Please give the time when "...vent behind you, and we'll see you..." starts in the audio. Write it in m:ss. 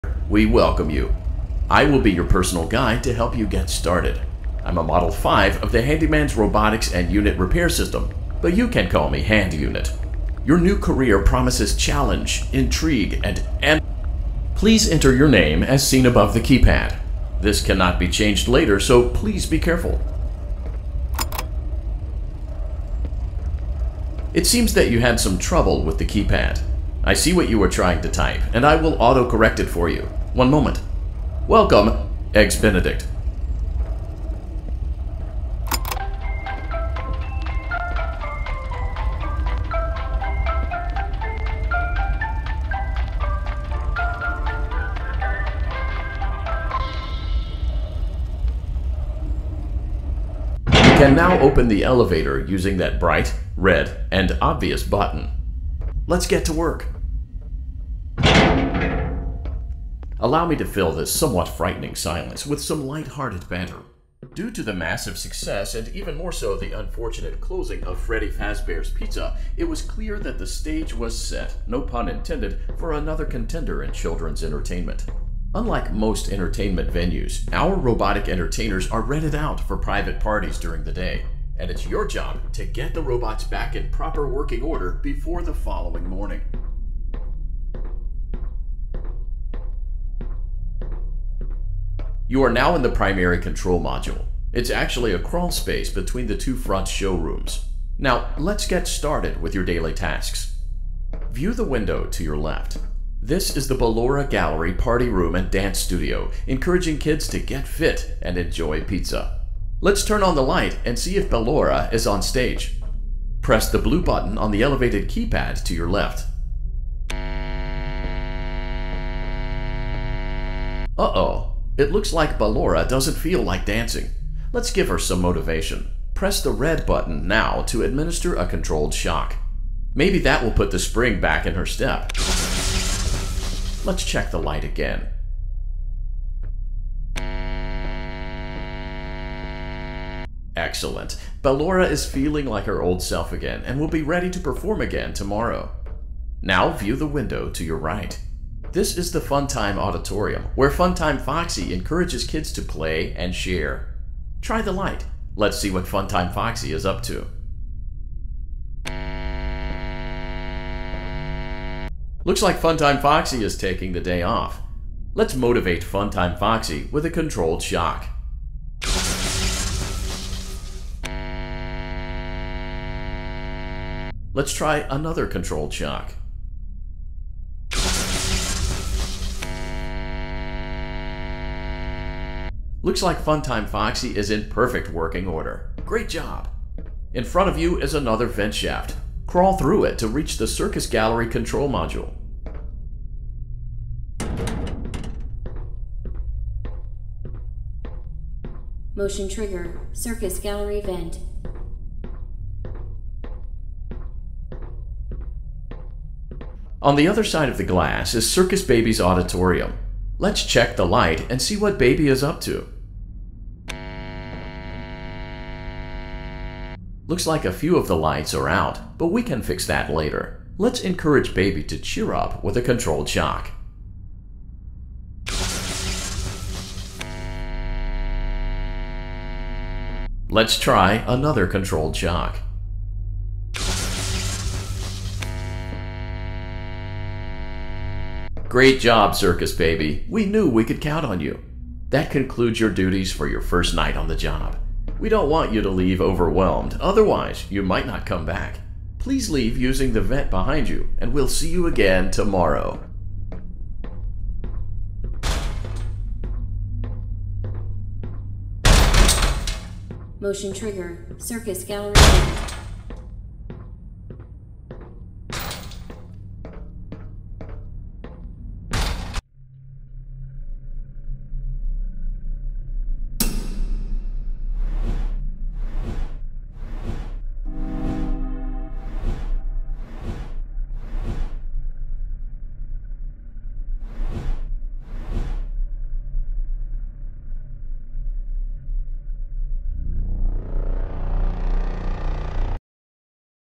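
4:10.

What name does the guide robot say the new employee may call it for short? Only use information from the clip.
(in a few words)
Hand Unit.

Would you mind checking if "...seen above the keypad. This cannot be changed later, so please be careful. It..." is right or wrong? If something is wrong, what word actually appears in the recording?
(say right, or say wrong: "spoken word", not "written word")
right.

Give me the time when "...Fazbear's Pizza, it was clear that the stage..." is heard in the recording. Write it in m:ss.
1:08.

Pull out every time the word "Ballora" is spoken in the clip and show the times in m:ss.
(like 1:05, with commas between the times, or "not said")
1:43, 1:51, 2:02, 2:21.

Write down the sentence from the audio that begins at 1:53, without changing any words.
Press the blue button on the elevated keypad to your left.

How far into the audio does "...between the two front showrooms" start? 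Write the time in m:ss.
1:35.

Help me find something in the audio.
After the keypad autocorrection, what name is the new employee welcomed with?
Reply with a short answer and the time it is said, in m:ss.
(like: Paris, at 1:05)
Eggs Benedict, at 0:32.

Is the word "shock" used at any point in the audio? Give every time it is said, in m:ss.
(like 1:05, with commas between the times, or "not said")
2:08, 2:47, 2:55, 3:43, 3:51.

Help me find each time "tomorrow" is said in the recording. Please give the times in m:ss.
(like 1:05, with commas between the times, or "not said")
2:25, 4:12.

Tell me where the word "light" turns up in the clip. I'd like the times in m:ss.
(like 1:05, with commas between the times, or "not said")
1:02, 1:50, 2:14, 2:34, 3:30, 3:37.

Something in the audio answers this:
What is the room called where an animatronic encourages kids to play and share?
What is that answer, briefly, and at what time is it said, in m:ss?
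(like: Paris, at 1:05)
Funtime Auditorium, at 2:29.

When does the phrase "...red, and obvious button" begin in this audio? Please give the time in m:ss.
0:53.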